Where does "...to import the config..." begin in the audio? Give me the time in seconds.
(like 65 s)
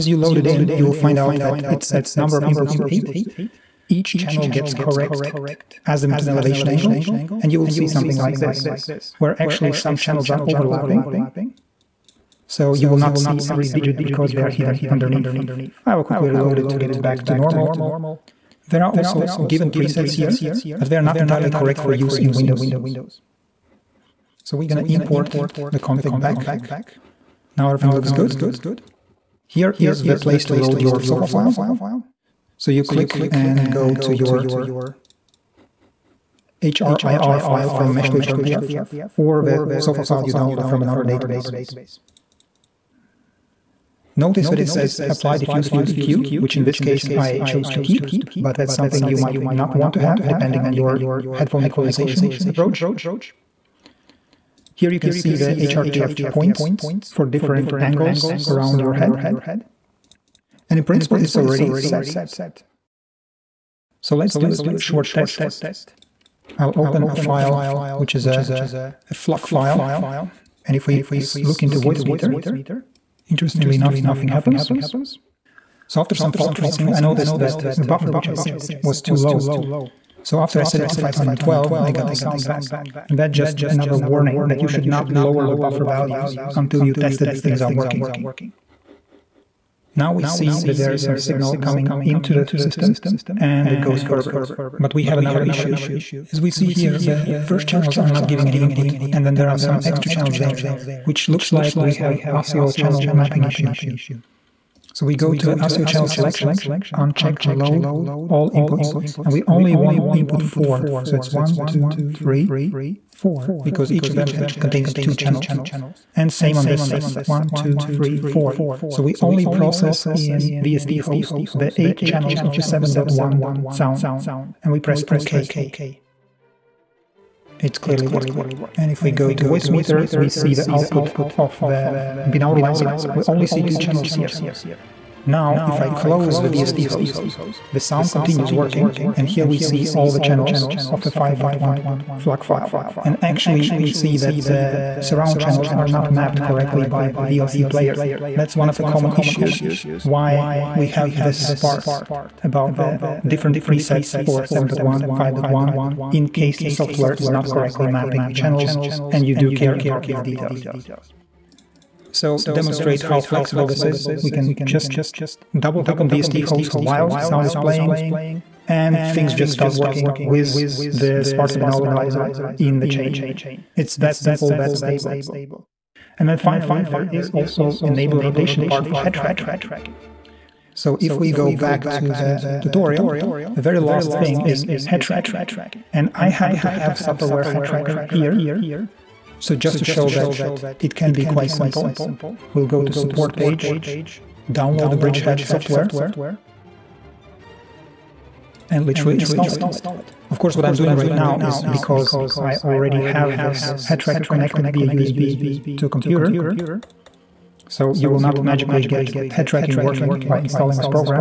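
24 s.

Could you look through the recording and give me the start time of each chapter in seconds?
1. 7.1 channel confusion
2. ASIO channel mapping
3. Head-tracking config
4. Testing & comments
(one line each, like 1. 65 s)
1. 127 s
2. 95 s
3. 175 s
4. 62 s.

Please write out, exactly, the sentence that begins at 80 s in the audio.
So after I set it to 512, I got the sound back.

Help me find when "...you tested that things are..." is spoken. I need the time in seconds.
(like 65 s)
86 s.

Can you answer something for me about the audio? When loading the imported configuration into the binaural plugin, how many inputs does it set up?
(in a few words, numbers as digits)
8.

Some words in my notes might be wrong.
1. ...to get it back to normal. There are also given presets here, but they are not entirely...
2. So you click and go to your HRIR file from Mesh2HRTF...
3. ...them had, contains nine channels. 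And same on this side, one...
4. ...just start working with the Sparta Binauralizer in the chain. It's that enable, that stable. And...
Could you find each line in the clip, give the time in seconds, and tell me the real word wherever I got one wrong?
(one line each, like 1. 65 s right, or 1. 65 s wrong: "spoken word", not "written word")
1. 16 s right
2. 32 s right
3. 114 s wrong: "two", not "nine"
4. 169 s wrong: "simple", not "enable".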